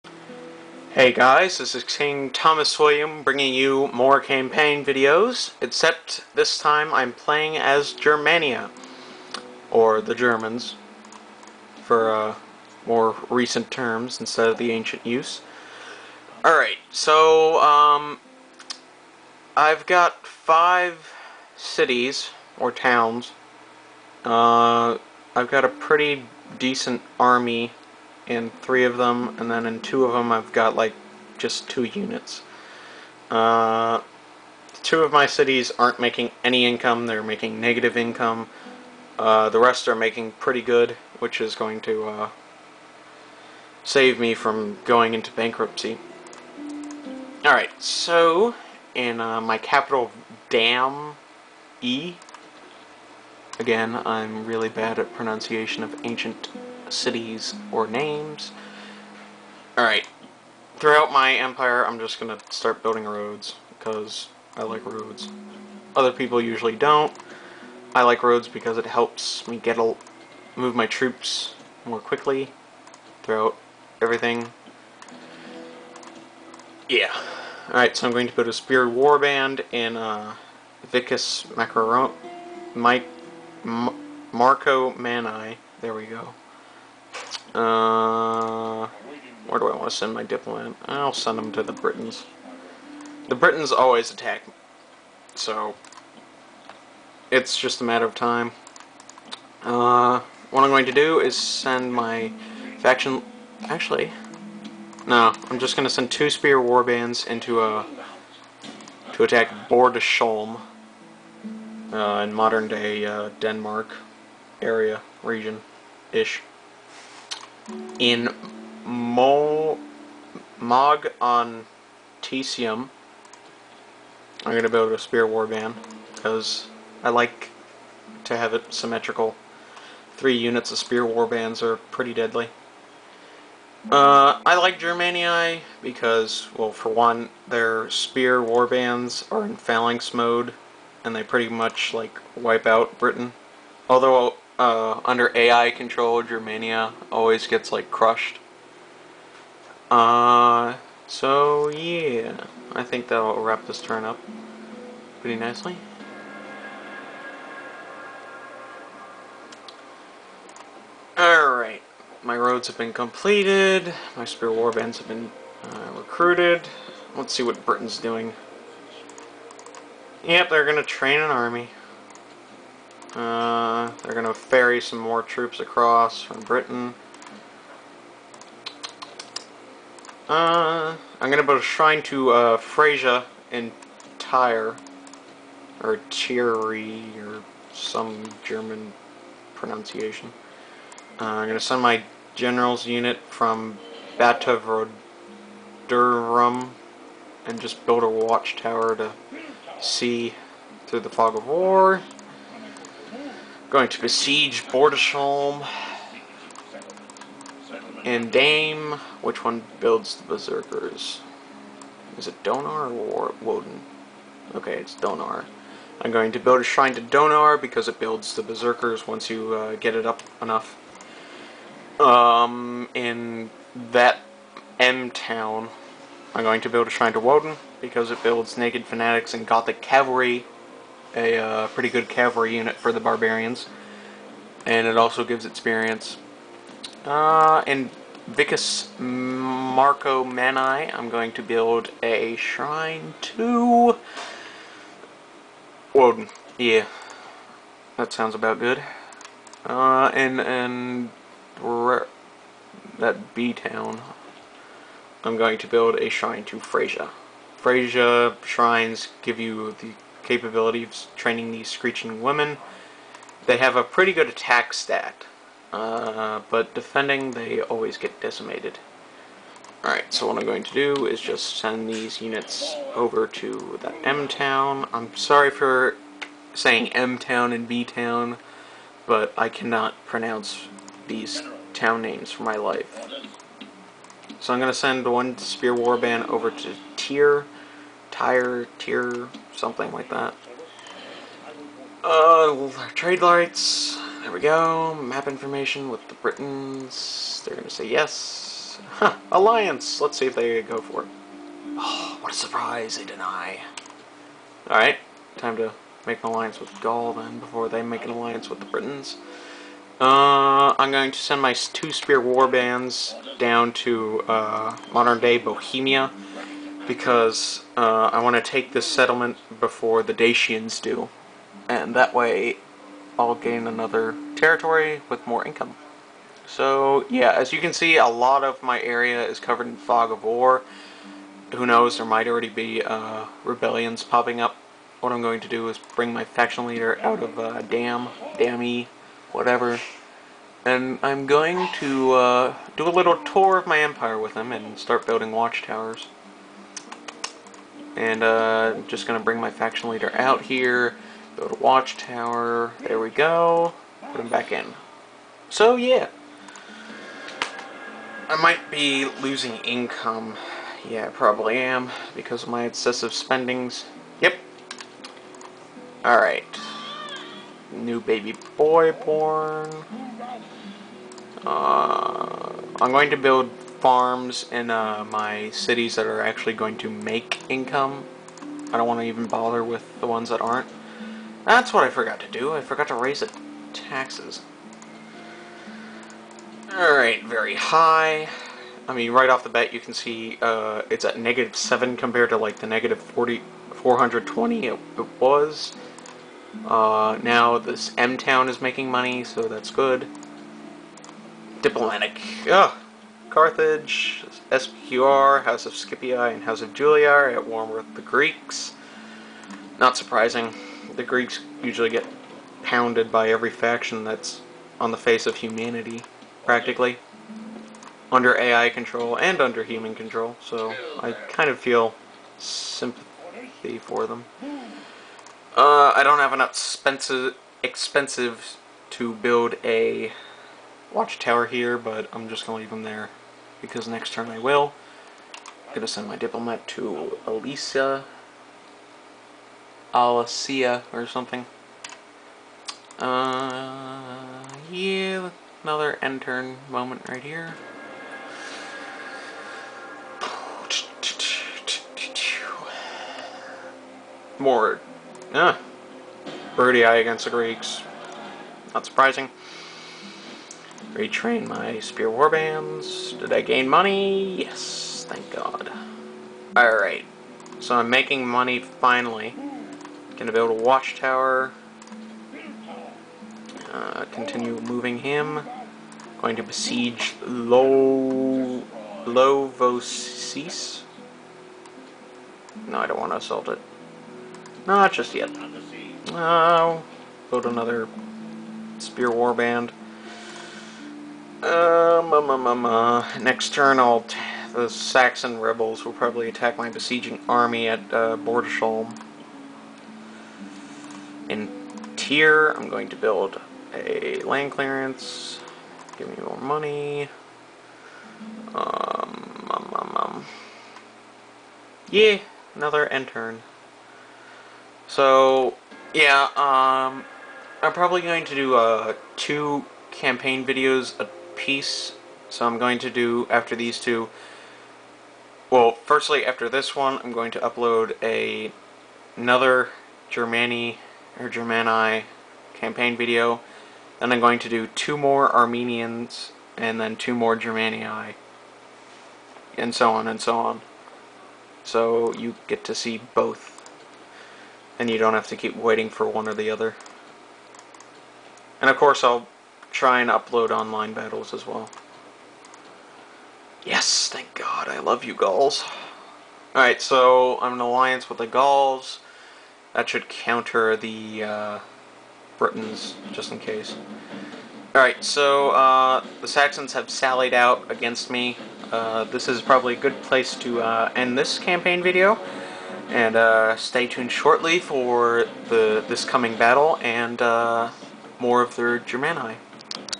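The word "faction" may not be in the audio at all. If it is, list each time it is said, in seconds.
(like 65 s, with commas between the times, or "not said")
102 s, 336 s, 349 s, 413 s.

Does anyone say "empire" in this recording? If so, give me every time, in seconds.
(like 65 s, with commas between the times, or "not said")
61 s, 343 s.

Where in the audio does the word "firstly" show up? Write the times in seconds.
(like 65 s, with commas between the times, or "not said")
525 s.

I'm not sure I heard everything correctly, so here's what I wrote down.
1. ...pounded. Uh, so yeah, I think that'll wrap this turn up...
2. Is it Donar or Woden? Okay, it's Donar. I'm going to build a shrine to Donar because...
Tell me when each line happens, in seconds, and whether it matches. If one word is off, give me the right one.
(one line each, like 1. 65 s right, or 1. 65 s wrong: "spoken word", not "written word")
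1. 147 s wrong: "crushed", not "pounded"
2. 212 s right.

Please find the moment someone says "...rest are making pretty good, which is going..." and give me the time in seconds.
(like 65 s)
39 s.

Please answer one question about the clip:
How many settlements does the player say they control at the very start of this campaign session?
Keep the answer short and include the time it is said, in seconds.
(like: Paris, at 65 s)
5, at 20 s.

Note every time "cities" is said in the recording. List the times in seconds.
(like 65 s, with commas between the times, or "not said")
21 s, 35 s, 56 s, 375 s.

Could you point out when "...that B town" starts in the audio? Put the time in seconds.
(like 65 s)
252 s.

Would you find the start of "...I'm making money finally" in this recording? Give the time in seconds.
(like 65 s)
467 s.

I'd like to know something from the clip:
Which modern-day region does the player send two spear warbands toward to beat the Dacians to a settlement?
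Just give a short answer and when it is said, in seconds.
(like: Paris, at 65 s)
Bohemia, at 315 s.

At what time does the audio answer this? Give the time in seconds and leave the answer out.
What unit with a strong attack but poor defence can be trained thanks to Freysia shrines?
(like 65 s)
261 s.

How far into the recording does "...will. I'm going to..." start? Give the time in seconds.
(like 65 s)
434 s.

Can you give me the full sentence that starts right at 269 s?
Alright, so what I'm going to do is just send these units over to that M-Town.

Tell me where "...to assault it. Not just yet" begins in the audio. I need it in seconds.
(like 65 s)
483 s.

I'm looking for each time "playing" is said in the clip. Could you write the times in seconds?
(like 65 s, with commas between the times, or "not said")
7 s.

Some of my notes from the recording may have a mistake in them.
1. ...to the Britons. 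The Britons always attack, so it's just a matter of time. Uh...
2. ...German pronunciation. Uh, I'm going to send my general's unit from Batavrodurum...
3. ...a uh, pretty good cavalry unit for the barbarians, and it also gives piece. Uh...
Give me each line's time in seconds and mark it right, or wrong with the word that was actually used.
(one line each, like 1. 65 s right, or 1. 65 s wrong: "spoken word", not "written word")
1. 91 s right
2. 188 s right
3. 231 s wrong: "experience", not "piece".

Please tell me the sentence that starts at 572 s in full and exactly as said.
And uh, stay tuned shortly for the this coming battle and uh, more of their Germani.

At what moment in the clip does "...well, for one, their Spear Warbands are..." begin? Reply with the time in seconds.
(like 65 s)
136 s.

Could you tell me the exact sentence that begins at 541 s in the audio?
So you get to see both and you don't have to keep waiting for one or the other.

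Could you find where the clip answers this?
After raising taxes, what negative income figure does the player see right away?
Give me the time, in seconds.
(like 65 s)
391 s.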